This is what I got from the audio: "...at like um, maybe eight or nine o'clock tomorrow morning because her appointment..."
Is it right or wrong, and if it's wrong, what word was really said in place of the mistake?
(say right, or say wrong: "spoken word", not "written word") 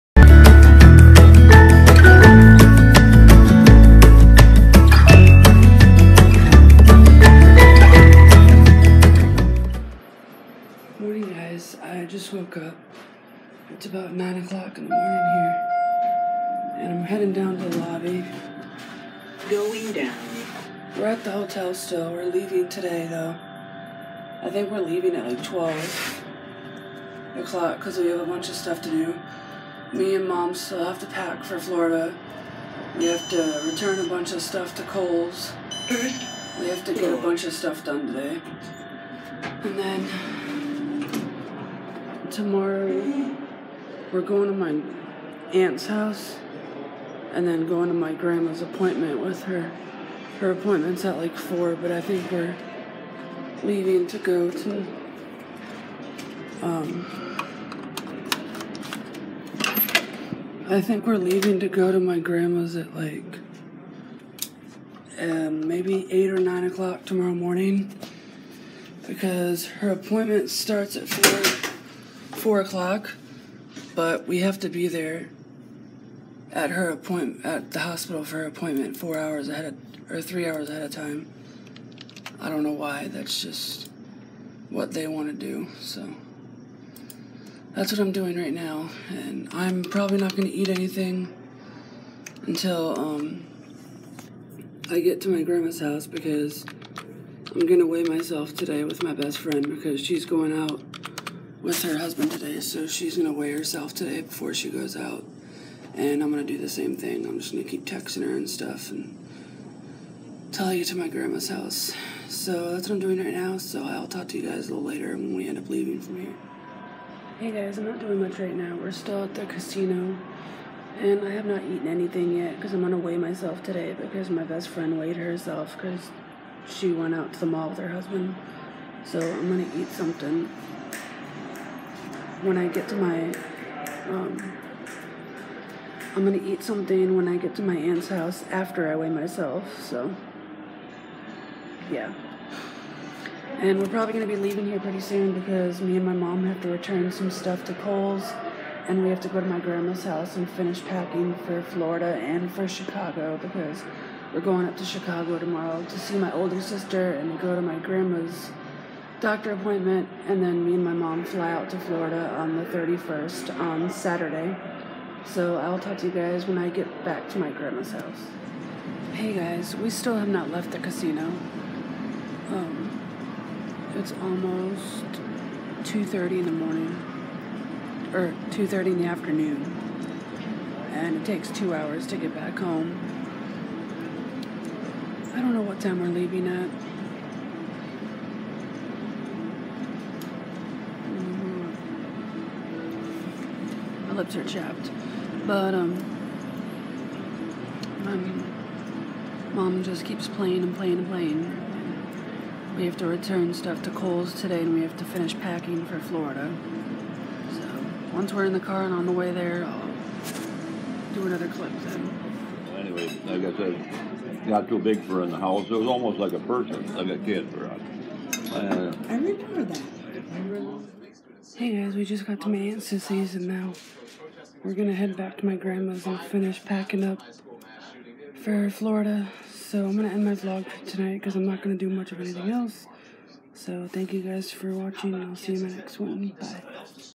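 right.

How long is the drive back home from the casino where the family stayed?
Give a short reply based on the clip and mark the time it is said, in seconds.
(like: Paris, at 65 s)
2 hours, at 181 s.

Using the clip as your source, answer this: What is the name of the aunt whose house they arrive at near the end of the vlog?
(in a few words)
Sissy.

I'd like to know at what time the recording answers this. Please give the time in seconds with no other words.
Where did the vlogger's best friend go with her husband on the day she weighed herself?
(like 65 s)
127 s.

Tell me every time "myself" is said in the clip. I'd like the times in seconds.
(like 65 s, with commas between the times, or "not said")
98 s, 123 s, 139 s.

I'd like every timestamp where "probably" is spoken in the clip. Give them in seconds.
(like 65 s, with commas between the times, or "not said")
89 s, 143 s.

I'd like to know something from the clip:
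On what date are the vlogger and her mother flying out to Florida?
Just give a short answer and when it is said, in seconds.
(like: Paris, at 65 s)
the 31st, at 162 s.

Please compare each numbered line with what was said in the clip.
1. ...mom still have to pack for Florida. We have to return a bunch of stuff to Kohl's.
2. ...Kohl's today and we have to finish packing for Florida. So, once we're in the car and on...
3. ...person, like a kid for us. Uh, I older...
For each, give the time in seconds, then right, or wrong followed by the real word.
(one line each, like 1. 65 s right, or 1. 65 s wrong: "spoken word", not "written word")
1. 30 s right
2. 203 s right
3. 216 s wrong: "remember", not "older".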